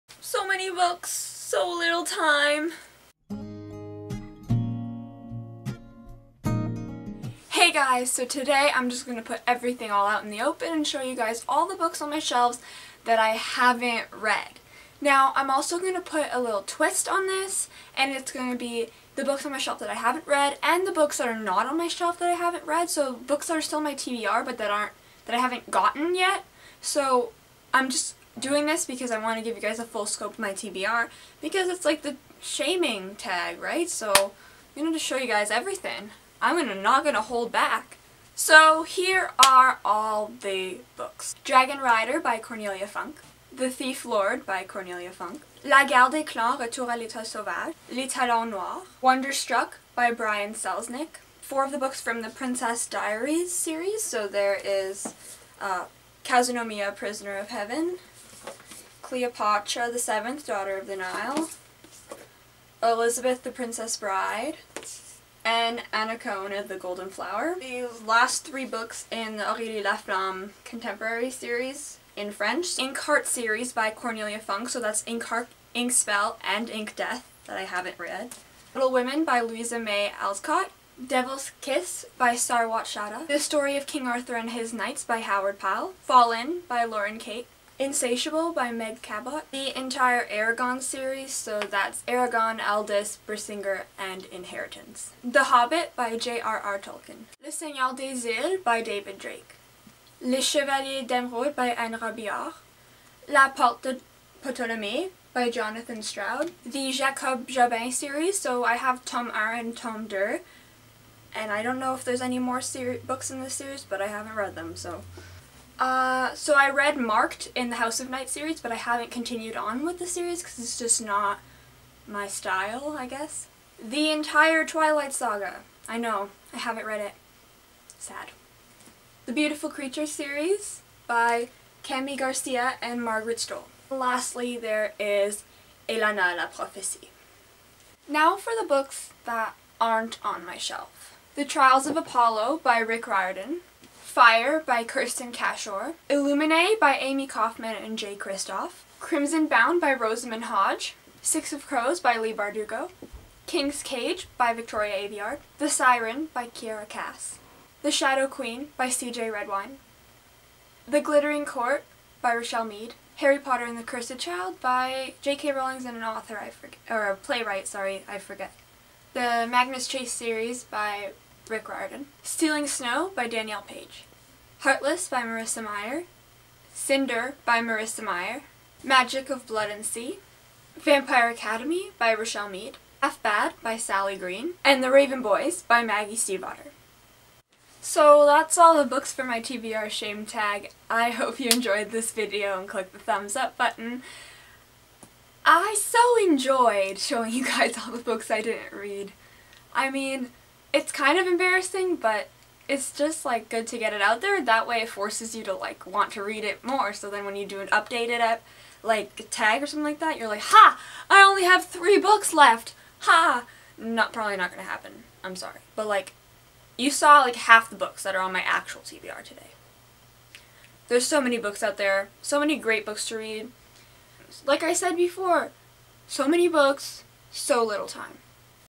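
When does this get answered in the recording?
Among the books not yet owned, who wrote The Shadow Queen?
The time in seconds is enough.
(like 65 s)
158 s.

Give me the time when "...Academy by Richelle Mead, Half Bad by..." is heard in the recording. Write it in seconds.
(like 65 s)
181 s.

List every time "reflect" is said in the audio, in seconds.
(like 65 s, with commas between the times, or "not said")
not said.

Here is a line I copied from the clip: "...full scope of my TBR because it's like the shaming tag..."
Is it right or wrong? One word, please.
right.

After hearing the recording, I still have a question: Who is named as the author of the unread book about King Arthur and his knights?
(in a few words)
Howard Pyle.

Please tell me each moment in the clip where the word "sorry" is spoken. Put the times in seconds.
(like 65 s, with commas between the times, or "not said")
167 s, 215 s.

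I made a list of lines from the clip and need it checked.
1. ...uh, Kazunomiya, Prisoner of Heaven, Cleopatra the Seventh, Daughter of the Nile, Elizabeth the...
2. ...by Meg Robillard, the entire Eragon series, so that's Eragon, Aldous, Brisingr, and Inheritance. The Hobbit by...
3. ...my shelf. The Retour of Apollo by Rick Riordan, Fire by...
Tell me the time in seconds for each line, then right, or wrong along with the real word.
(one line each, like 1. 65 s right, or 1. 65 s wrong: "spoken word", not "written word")
1. 55 s right
2. 88 s wrong: "Cabot", not "Robillard"
3. 140 s wrong: "Trials", not "Retour".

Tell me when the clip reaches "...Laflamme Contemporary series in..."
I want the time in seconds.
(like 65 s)
69 s.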